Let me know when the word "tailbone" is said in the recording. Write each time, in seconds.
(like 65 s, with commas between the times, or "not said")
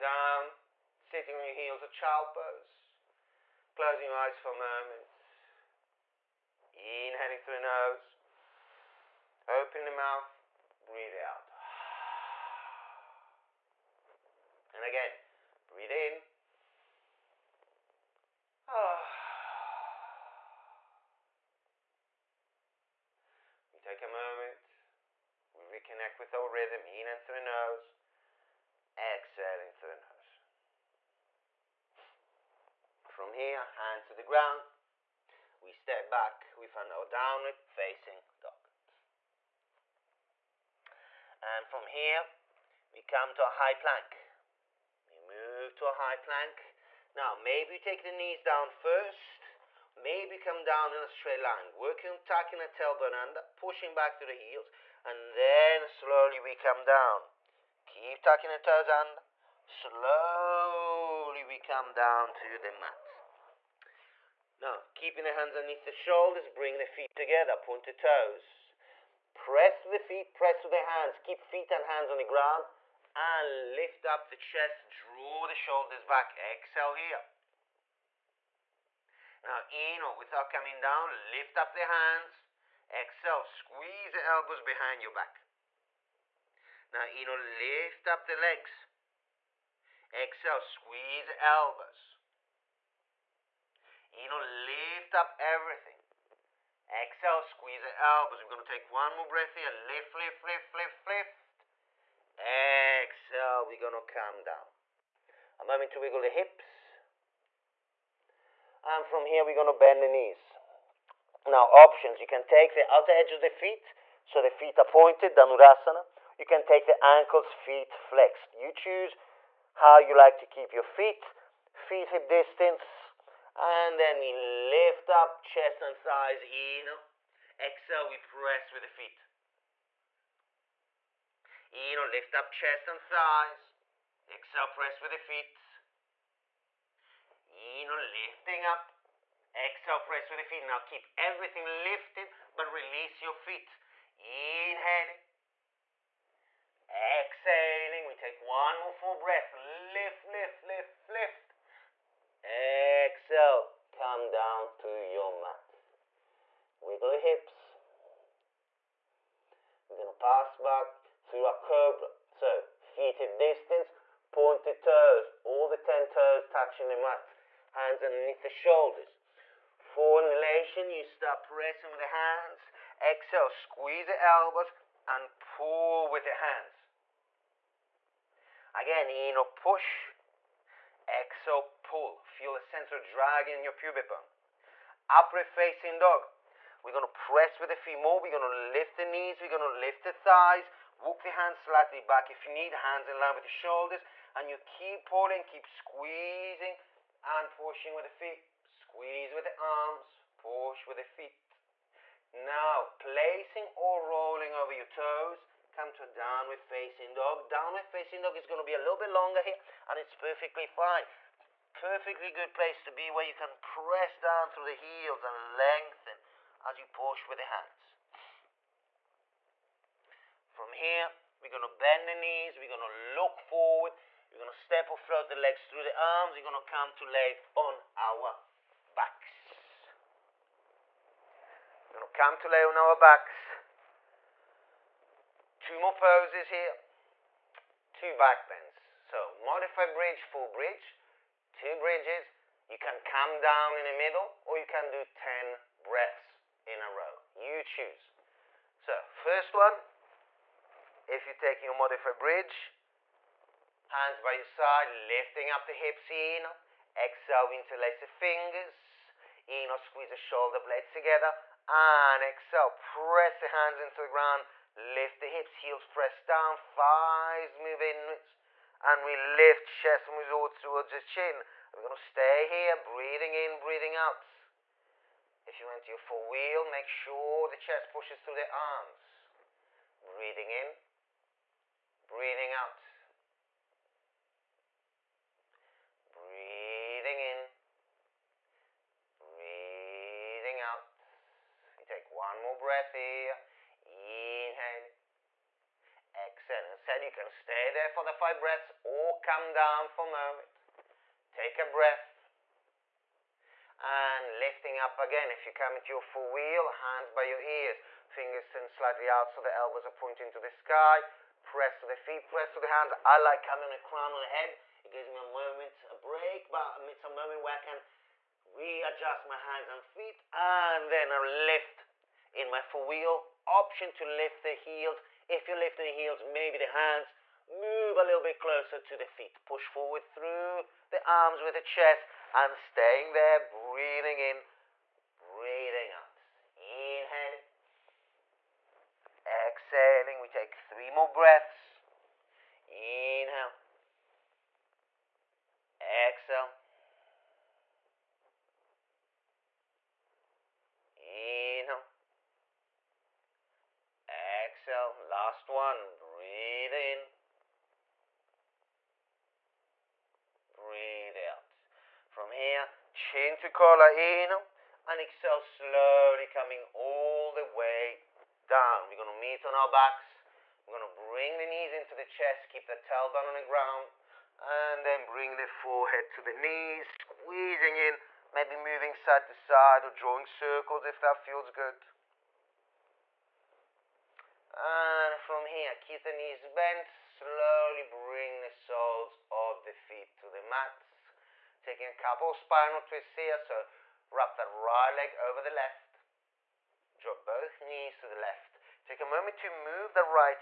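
52 s, 372 s.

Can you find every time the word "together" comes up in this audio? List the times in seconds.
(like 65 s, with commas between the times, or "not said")
67 s, 260 s.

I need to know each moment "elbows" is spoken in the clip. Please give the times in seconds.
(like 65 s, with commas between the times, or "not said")
84 s, 91 s, 98 s, 174 s, 309 s.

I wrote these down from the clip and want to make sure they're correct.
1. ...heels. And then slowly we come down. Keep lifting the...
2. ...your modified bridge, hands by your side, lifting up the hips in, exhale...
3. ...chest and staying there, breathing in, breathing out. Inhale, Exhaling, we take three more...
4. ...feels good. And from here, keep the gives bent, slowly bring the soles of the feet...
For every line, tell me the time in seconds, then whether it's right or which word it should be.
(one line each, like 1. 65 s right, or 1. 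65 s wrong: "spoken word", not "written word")
1. 54 s wrong: "tucking", not "lifting"
2. 251 s right
3. 331 s right
4. 381 s wrong: "knees", not "gives".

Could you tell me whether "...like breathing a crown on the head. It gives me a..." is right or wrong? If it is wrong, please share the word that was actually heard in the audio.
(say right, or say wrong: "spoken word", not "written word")
wrong: "having", not "breathing".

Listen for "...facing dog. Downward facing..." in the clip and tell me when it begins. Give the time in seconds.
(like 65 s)
206 s.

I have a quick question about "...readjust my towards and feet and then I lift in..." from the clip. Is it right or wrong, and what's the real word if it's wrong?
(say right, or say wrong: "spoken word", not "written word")
wrong: "hands", not "towards".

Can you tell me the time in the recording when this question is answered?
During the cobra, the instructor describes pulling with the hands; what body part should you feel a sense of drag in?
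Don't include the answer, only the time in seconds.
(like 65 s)
183 s.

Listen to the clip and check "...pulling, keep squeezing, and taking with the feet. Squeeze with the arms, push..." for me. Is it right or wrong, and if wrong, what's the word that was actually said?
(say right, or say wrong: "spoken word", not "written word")
wrong: "pushing", not "taking".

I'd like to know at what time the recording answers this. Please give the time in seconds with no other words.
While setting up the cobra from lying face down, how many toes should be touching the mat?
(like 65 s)
165 s.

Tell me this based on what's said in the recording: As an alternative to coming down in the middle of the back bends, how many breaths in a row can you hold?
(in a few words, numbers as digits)
10.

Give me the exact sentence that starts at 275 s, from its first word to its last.
If you went to your four wheel, make sure the chest pushes through the arms.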